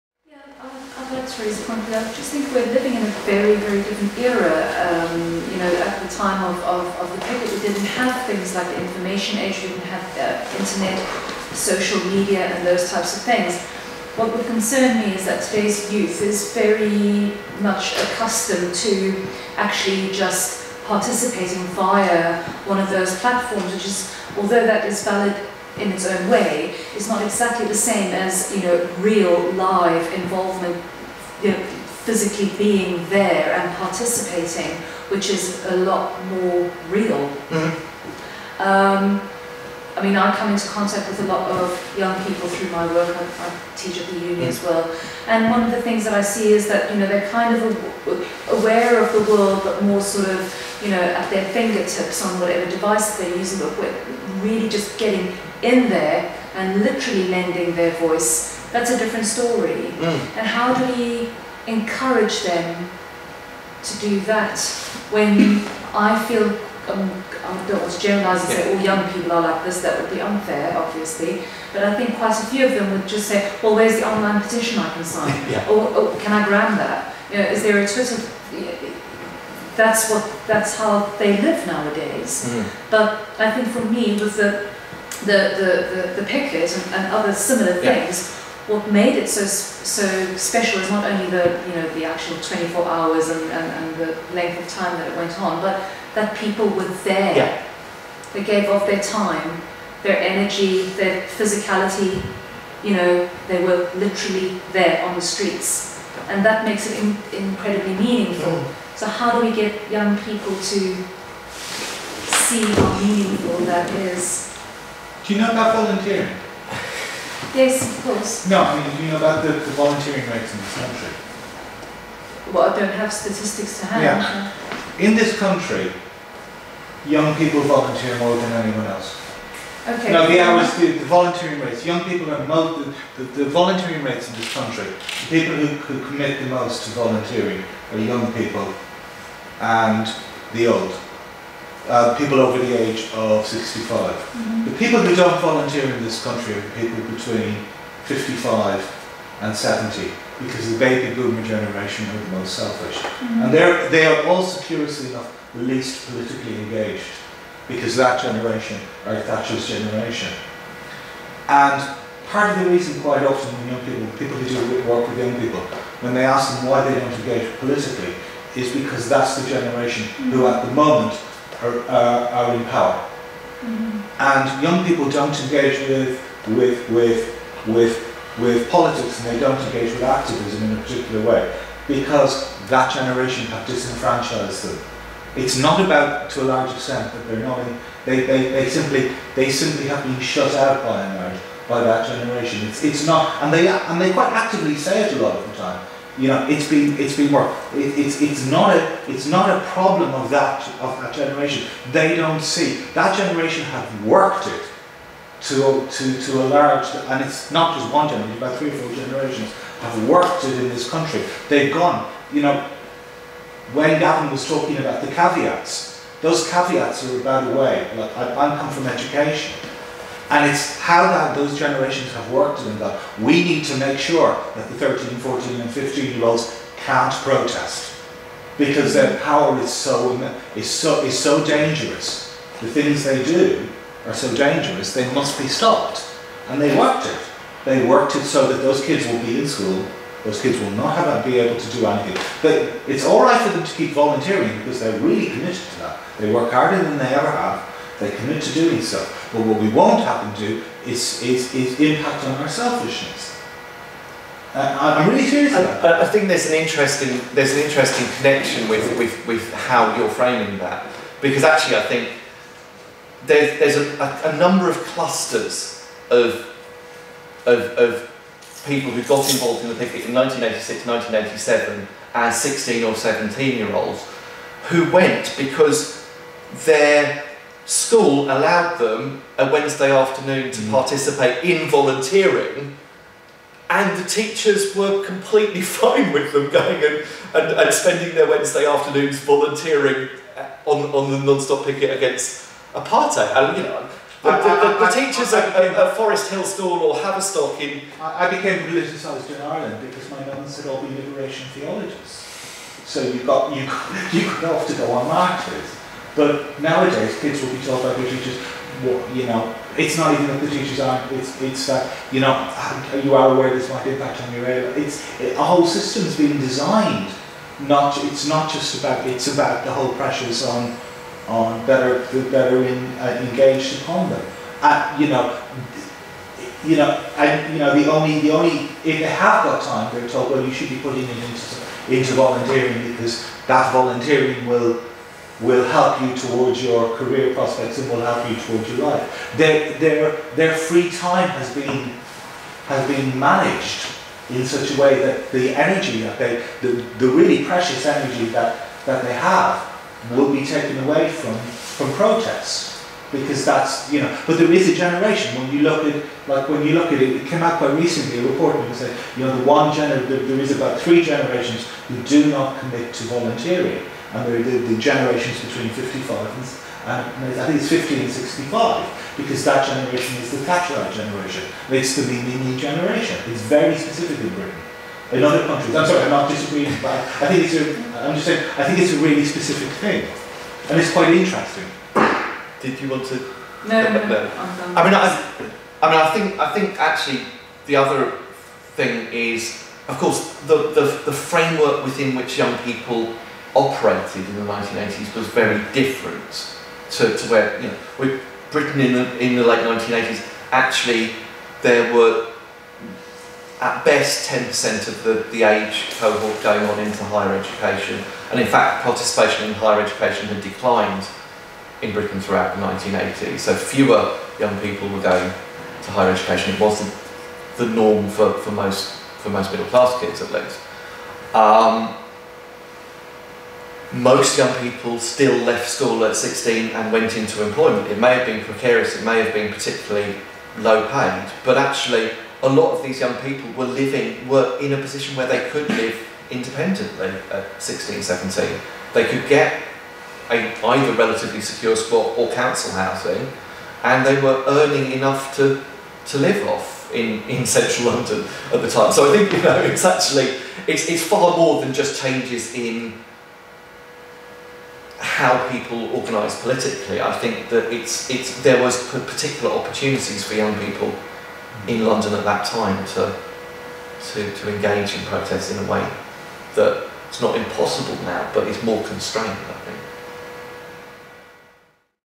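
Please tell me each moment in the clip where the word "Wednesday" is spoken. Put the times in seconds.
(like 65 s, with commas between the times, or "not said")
279 s, 288 s.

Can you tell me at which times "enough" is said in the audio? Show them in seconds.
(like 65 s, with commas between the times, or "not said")
155 s, 444 s.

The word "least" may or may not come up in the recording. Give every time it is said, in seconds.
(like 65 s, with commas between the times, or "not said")
155 s, 420 s.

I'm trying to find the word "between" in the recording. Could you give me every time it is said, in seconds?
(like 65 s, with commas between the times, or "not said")
147 s, 365 s.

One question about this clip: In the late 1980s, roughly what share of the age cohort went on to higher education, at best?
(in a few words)
10%.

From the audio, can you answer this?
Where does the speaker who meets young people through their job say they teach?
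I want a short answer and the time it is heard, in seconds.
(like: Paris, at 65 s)
the uni, at 44 s.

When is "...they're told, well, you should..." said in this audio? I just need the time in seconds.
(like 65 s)
329 s.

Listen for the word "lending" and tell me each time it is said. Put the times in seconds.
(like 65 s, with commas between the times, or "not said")
57 s.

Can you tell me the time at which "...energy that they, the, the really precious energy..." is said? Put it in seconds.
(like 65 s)
345 s.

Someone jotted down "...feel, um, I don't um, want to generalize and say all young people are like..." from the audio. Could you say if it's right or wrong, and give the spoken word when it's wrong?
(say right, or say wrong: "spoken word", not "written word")
right.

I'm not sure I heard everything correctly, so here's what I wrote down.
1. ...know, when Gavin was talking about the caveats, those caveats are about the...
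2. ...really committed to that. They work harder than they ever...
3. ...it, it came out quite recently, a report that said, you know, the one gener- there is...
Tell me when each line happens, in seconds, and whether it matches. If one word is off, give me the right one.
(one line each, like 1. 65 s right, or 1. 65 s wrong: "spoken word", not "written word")
1. 212 s right
2. 245 s right
3. 357 s right.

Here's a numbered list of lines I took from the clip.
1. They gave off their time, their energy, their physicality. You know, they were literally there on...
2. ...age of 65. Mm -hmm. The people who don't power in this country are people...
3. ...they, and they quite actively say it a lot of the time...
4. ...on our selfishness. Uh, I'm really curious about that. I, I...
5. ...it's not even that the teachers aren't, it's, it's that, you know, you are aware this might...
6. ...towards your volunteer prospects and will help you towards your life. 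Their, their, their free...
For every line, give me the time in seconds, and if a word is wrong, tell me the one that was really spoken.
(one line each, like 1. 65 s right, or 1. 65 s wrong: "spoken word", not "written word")
1. 98 s right
2. 142 s wrong: "volunteer", not "power"
3. 193 s right
4. 252 s right
5. 309 s right
6. 336 s wrong: "career", not "volunteer".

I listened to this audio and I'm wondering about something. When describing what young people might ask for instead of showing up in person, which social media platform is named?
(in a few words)
Twitter.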